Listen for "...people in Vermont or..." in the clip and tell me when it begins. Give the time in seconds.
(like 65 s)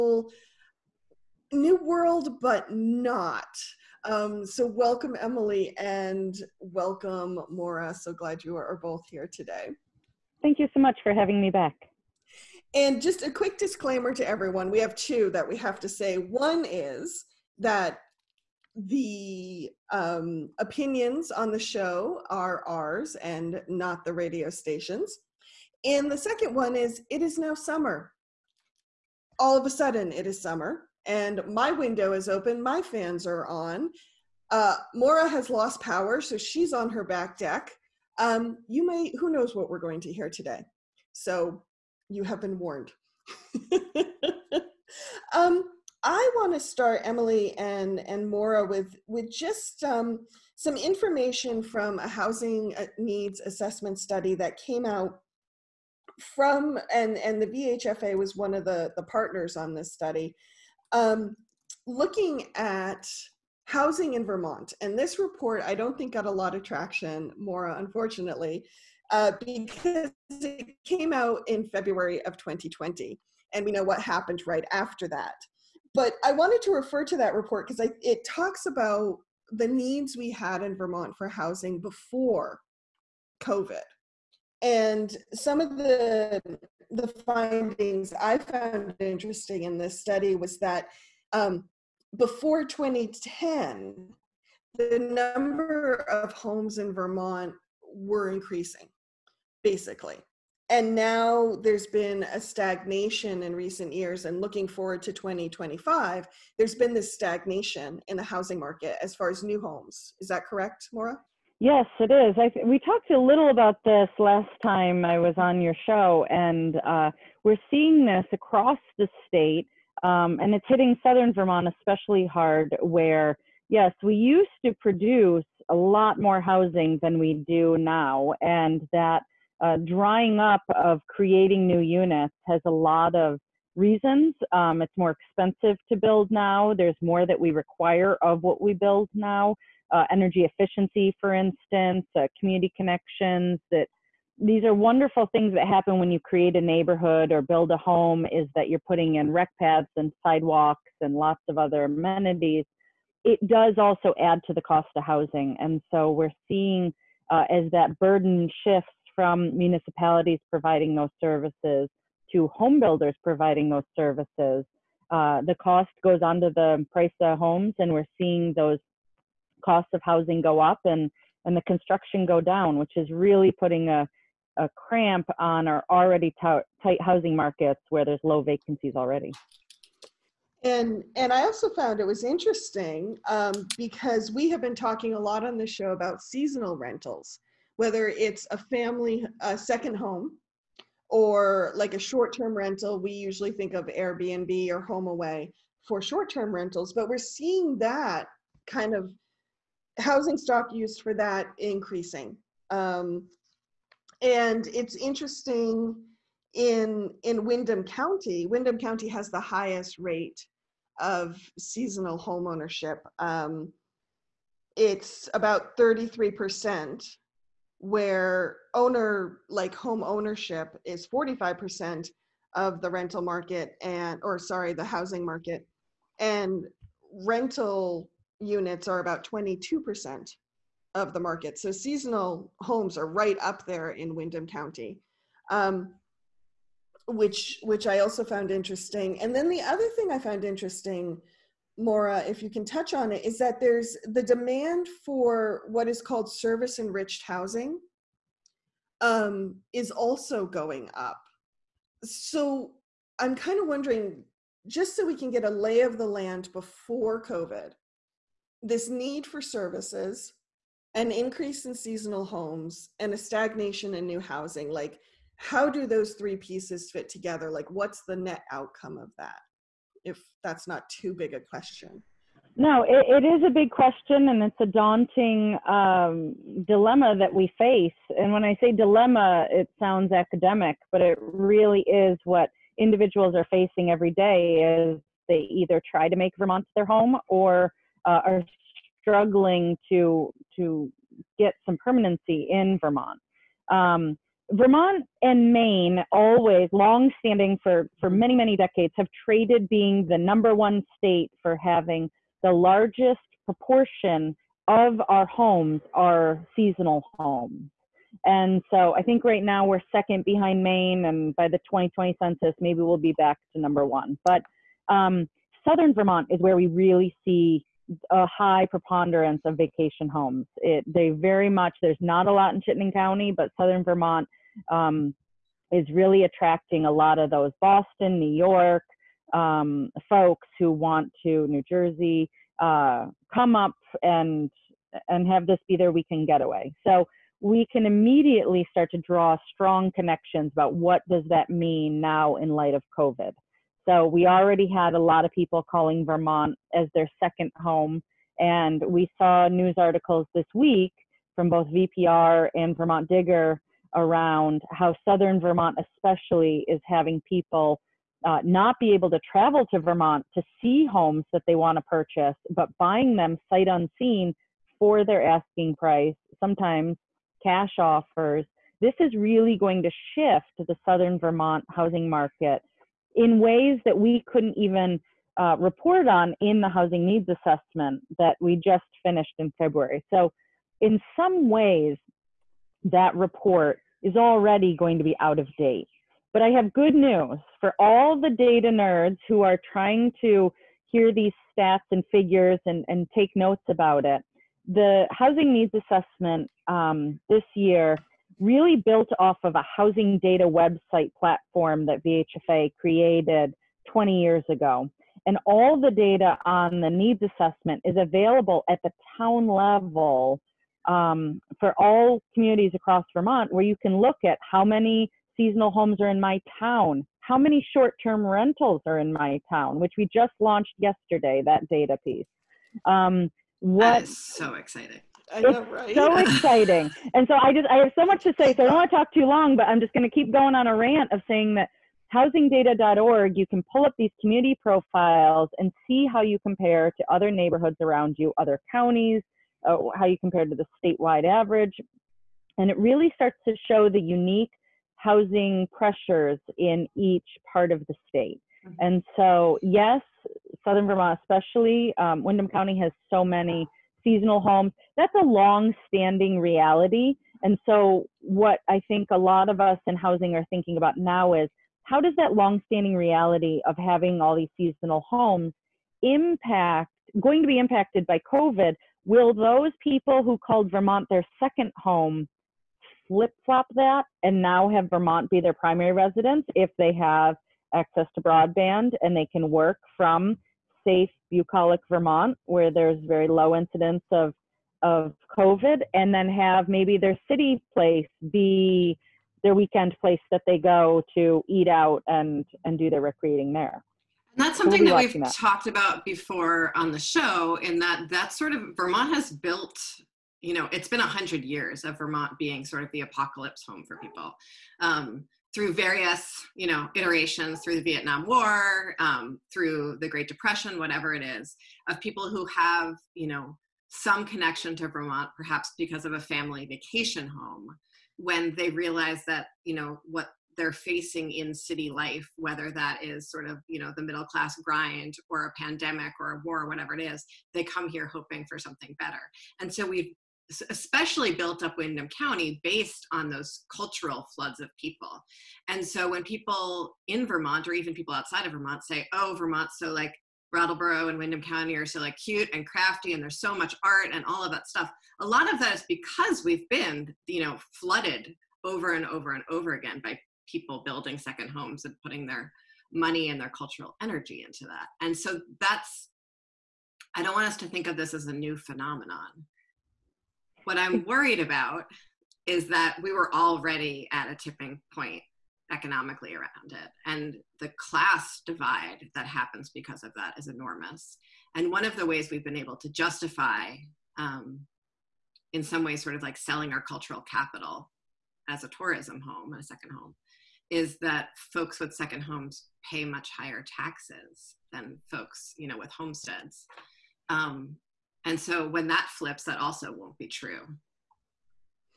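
536 s.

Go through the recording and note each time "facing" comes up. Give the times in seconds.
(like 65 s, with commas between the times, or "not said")
283 s, 520 s.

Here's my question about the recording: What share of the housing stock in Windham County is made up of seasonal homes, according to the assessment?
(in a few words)
33%.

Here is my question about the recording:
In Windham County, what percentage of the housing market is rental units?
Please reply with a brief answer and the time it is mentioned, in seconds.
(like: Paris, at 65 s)
22%, at 229 s.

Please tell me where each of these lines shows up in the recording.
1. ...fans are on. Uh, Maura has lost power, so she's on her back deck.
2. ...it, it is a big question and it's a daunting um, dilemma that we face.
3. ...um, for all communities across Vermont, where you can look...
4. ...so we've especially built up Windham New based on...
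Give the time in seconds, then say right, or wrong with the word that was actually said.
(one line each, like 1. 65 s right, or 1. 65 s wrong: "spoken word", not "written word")
1. 32 s right
2. 272 s right
3. 410 s right
4. 529 s wrong: "County", not "New".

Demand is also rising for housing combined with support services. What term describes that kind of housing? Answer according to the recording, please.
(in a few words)
service enriched housing.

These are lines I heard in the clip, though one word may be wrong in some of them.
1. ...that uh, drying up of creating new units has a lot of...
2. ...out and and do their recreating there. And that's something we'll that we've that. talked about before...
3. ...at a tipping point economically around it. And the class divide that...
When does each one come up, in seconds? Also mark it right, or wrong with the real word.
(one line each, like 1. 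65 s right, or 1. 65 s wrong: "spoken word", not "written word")
1. 128 s right
2. 491 s right
3. 564 s right.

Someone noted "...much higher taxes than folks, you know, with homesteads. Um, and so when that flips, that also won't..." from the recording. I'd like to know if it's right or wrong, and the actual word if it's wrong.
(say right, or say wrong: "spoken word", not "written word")
right.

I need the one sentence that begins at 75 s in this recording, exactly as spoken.
But I wanted to refer to that report because it talks about the needs we had in Vermont for housing before COVID.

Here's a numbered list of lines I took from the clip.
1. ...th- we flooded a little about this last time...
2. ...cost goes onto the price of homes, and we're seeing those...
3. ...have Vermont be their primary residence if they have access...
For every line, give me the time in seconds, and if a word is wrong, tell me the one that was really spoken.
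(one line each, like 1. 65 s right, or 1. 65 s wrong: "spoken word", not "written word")
1. 112 s wrong: "talked", not "flooded"
2. 165 s right
3. 474 s right.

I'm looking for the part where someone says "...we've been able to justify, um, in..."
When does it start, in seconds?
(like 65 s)
572 s.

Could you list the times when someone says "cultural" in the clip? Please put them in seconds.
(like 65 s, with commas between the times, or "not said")
533 s, 553 s, 576 s.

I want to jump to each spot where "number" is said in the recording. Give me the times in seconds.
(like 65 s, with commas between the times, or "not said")
94 s, 300 s, 313 s.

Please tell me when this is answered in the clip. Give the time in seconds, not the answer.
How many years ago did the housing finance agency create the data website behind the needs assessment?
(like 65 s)
403 s.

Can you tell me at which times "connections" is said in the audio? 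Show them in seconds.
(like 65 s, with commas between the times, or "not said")
142 s, 339 s, 514 s.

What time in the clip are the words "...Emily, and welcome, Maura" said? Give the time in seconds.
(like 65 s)
5 s.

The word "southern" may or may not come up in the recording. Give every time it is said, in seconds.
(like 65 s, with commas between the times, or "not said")
121 s, 315 s, 323 s, 355 s, 370 s, 450 s.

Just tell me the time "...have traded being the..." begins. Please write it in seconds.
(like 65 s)
298 s.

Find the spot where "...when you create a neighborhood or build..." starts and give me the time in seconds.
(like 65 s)
145 s.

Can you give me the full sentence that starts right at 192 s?
We usually think of Airbnb or HomeAway for short-term rentals, but we're seeing that kind of housing stock used for that increasing.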